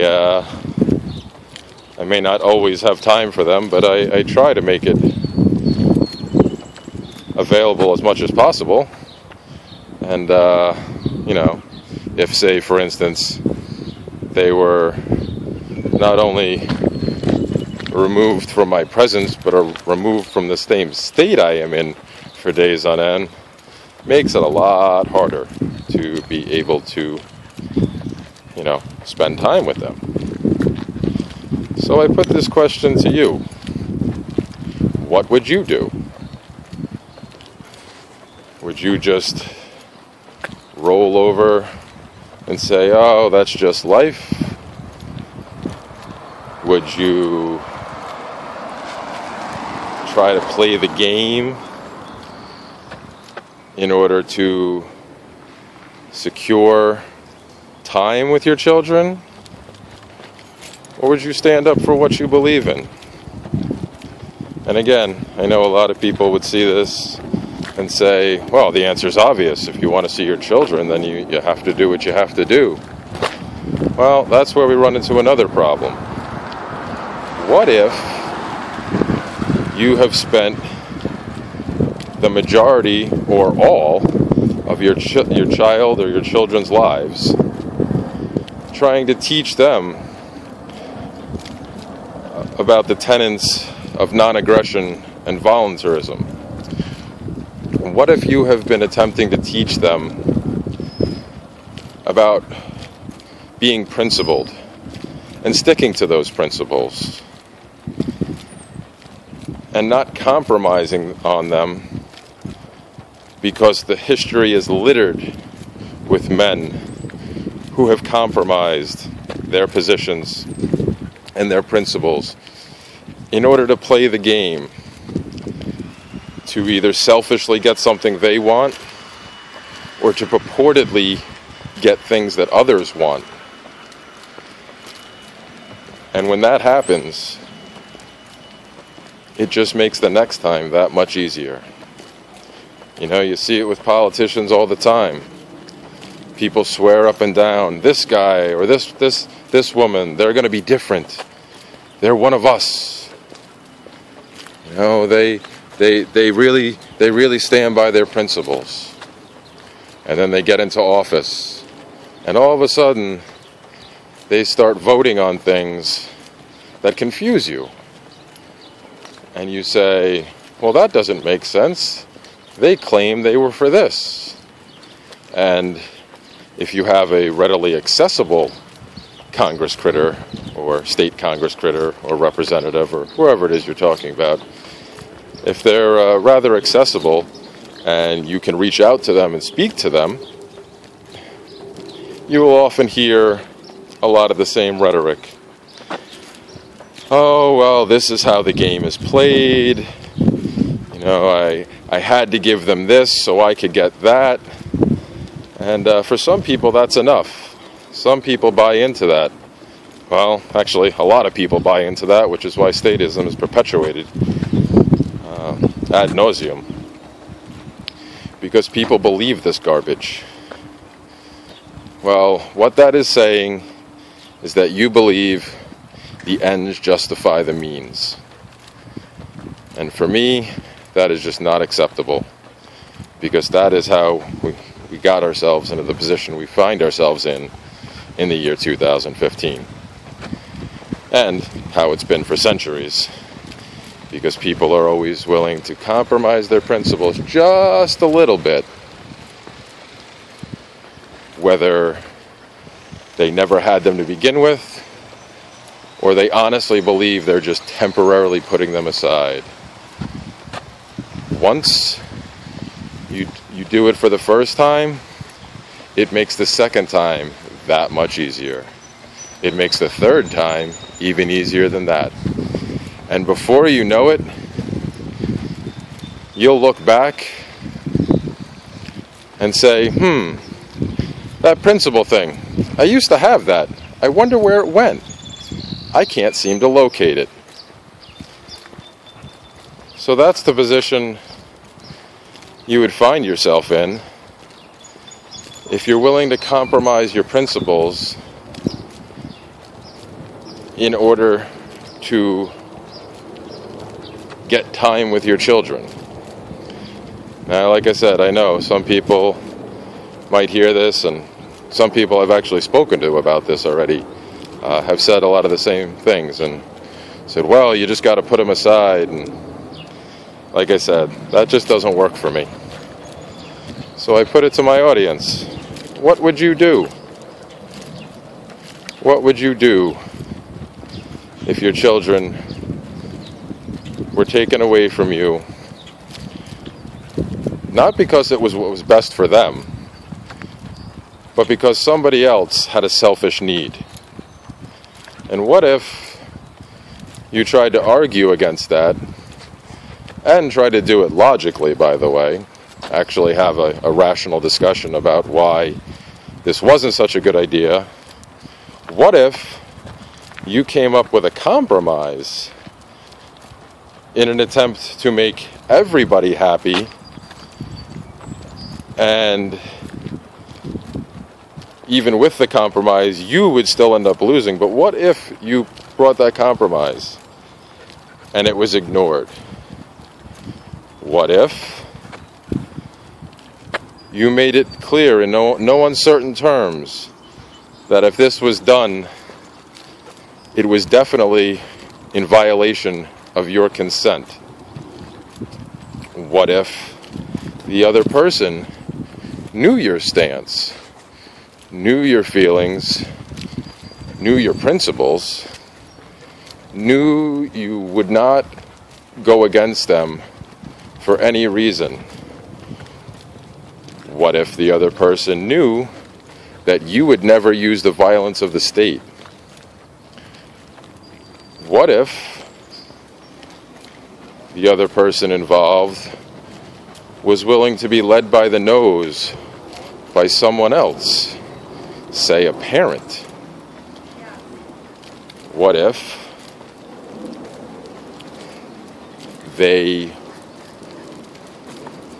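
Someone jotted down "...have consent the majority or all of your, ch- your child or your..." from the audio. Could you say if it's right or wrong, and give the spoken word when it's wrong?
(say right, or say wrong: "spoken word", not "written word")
wrong: "spent", not "consent".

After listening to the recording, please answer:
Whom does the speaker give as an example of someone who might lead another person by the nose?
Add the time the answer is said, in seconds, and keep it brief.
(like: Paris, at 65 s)
a parent, at 432 s.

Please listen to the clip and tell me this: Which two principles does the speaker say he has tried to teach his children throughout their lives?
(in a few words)
non aggression and voluntarism.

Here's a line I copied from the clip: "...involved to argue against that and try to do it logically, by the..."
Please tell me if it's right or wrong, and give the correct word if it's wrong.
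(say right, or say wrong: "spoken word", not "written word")
wrong: "tried", not "involved".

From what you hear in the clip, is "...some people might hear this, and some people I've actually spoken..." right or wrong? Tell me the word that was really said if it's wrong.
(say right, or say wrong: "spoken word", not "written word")
right.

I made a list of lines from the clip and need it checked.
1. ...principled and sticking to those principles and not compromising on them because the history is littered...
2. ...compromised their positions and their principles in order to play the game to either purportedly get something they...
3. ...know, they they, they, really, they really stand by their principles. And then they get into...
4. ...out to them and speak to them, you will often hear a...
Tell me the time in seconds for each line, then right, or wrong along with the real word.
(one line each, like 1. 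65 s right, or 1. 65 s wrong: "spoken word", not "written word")
1. 103 s right
2. 118 s wrong: "selfishly", not "purportedly"
3. 154 s right
4. 188 s right.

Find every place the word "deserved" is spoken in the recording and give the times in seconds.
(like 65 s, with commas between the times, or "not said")
not said.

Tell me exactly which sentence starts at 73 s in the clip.
Well, that's where we run into another problem.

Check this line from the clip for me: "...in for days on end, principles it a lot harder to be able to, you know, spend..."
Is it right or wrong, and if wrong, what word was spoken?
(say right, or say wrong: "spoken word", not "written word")
wrong: "makes", not "principles".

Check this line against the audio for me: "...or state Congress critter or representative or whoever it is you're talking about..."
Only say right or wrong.
right.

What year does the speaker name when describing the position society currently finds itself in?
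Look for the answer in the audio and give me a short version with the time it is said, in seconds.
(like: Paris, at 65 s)
2015, at 238 s.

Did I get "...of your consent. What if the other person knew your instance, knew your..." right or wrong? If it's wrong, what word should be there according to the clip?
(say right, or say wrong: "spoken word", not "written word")
wrong: "stance", not "instance".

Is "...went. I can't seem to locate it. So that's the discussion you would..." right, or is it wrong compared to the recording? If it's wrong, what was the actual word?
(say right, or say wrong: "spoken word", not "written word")
wrong: "position", not "discussion".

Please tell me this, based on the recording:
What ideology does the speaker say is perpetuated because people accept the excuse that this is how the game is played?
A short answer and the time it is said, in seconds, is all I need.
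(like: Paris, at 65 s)
statism, at 212 s.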